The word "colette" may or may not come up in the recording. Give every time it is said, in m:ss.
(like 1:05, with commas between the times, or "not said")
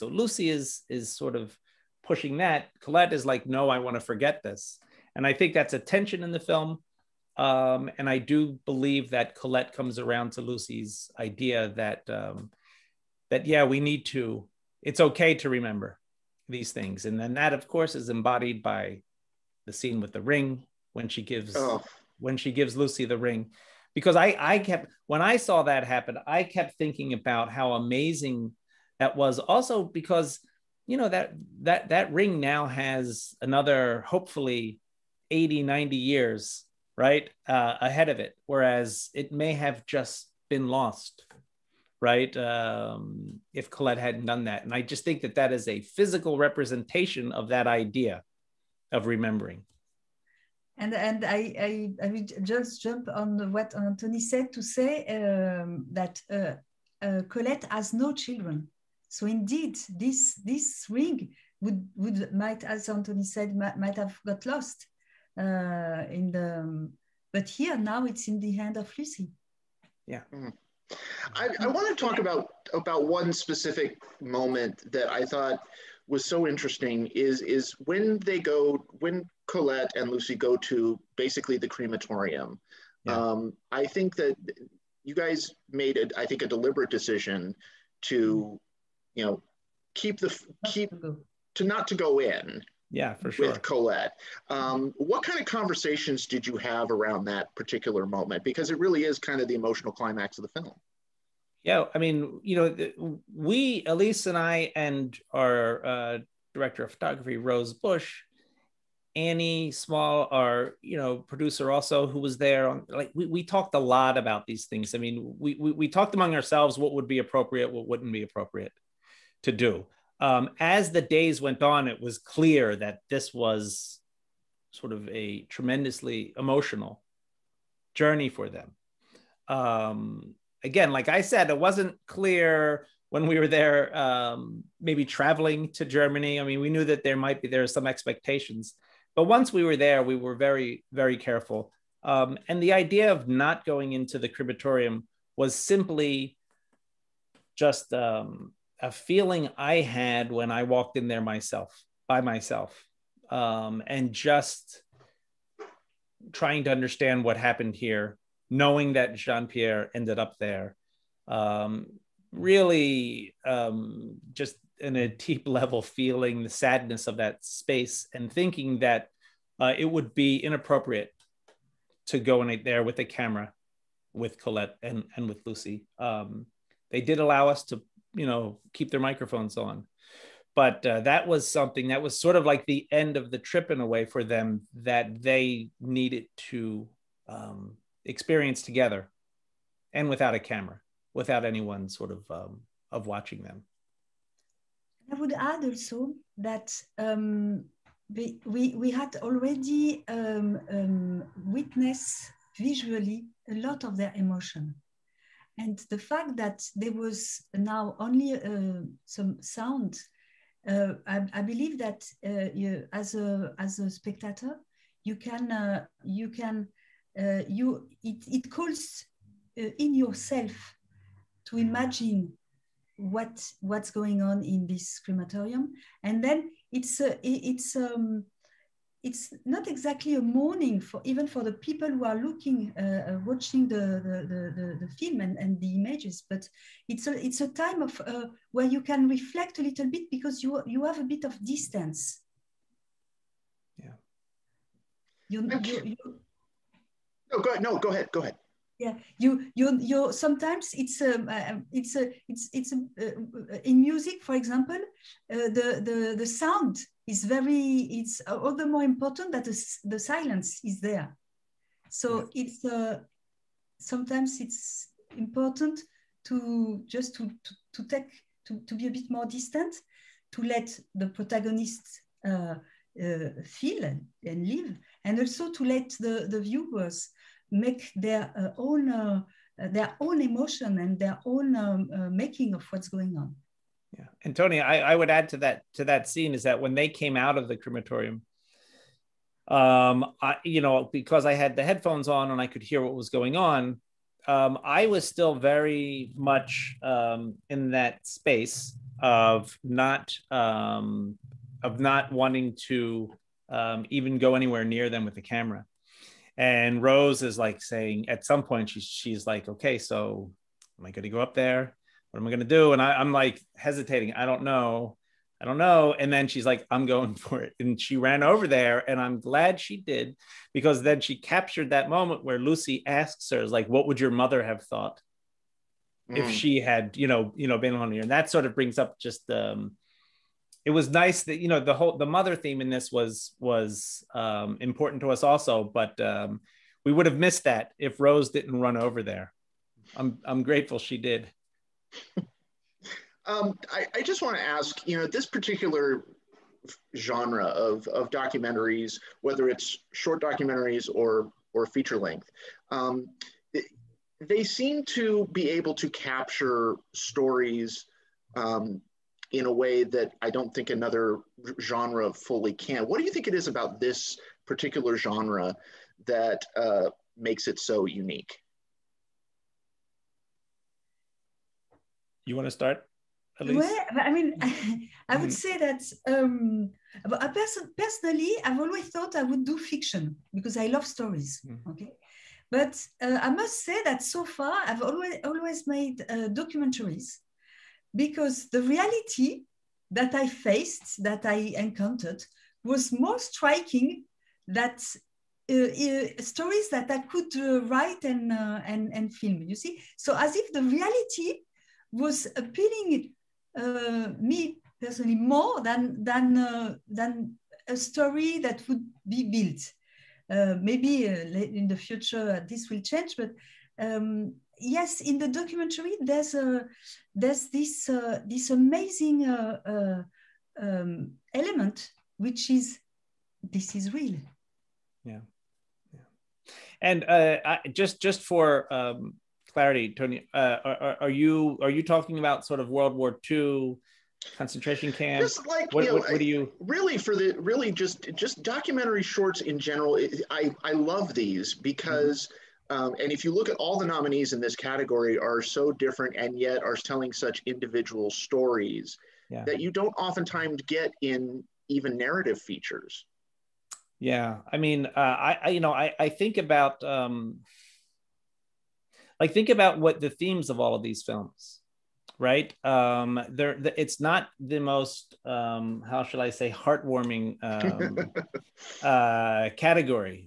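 0:02, 0:09, 0:43, 0:57, 1:19, 1:33, 2:54.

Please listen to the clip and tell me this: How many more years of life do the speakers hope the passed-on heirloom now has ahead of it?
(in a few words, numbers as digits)
80 90 years.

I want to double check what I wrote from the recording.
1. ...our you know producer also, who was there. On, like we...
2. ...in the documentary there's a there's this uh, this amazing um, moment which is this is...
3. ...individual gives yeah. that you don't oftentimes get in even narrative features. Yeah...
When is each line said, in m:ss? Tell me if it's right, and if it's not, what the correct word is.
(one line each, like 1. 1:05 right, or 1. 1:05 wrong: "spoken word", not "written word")
1. 1:50 right
2. 6:55 wrong: "element", not "moment"
3. 7:27 wrong: "stories", not "gives".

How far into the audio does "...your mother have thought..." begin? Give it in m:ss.
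5:23.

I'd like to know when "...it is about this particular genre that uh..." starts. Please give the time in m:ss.
6:03.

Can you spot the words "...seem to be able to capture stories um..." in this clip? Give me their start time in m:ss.
5:54.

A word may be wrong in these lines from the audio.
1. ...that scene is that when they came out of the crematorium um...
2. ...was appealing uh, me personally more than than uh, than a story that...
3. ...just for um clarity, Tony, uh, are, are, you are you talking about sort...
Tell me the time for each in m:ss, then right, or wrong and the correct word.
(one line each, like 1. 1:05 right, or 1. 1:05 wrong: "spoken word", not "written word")
1. 4:45 right
2. 6:41 right
3. 7:08 right.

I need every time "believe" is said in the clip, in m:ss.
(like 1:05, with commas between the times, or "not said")
0:08, 3:31.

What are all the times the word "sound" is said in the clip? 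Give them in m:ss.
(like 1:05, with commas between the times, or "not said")
3:29, 4:16.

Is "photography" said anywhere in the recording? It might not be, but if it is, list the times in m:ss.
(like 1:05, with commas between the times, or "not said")
1:46.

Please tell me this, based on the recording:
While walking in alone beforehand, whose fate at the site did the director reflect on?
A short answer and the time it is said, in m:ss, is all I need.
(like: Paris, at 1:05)
Jean Pierre, at 2:39.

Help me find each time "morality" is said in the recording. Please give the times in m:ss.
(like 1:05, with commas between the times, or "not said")
not said.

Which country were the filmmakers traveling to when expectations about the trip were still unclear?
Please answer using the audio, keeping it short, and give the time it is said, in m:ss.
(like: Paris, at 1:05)
Germany, at 2:15.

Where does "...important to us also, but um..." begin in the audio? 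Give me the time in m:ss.
5:34.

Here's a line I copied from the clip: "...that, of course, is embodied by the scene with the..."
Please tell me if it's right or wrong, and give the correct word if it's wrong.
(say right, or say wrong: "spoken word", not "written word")
right.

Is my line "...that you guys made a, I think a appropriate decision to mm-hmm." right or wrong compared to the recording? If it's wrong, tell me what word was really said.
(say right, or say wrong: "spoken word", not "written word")
wrong: "deliberate", not "appropriate".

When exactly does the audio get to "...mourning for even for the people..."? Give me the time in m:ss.
3:50.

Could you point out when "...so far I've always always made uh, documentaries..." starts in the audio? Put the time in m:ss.
6:24.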